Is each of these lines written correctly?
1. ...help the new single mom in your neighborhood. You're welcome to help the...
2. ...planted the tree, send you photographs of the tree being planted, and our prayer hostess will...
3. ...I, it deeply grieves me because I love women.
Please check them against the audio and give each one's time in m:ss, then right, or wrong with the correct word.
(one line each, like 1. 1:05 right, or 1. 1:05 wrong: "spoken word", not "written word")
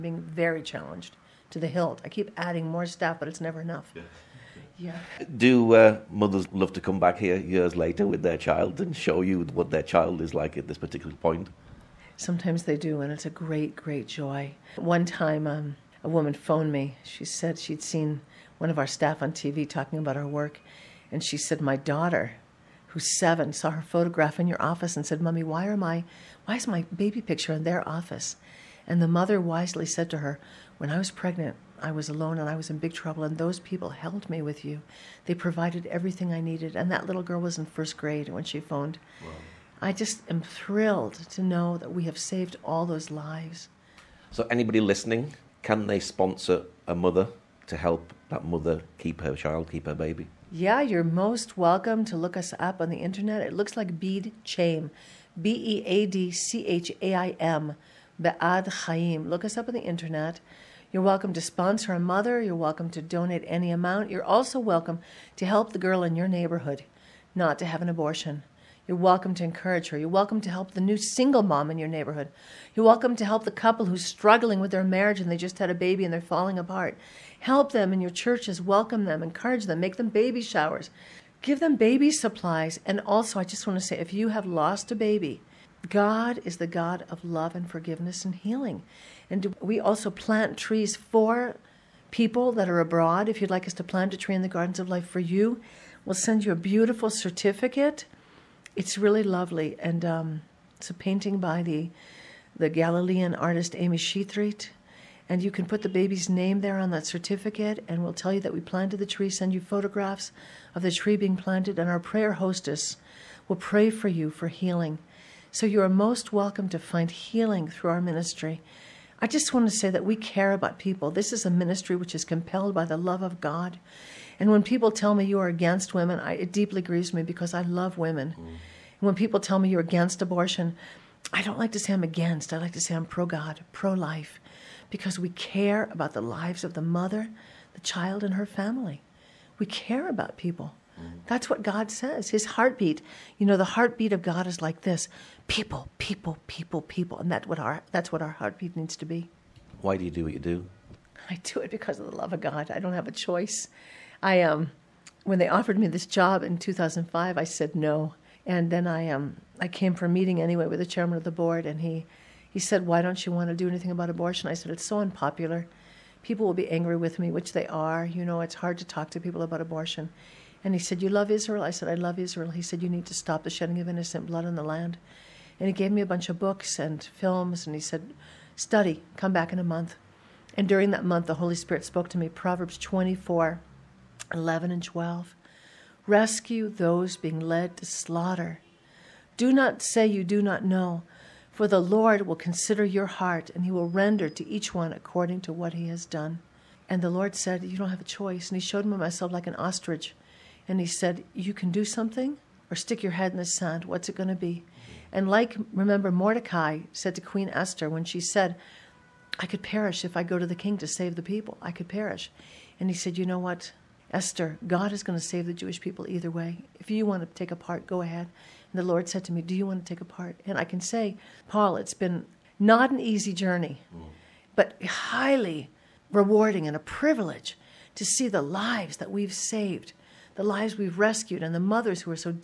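1. 1:10 right
2. 1:48 right
3. 2:06 right.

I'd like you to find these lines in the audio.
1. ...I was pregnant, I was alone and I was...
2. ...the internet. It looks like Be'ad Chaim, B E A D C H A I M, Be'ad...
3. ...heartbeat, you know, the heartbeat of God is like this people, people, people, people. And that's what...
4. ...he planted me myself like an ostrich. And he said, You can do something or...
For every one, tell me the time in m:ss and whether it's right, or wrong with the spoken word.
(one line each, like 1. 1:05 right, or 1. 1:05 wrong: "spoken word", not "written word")
1. 0:30 right
2. 0:52 right
3. 2:22 right
4. 3:18 wrong: "showed", not "planted".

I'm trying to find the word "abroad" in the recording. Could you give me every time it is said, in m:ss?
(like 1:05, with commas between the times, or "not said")
1:32.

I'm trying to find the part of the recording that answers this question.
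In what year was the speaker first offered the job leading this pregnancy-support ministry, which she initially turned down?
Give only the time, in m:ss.
2:36.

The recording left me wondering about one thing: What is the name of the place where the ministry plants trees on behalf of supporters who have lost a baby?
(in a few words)
Gardens of Life.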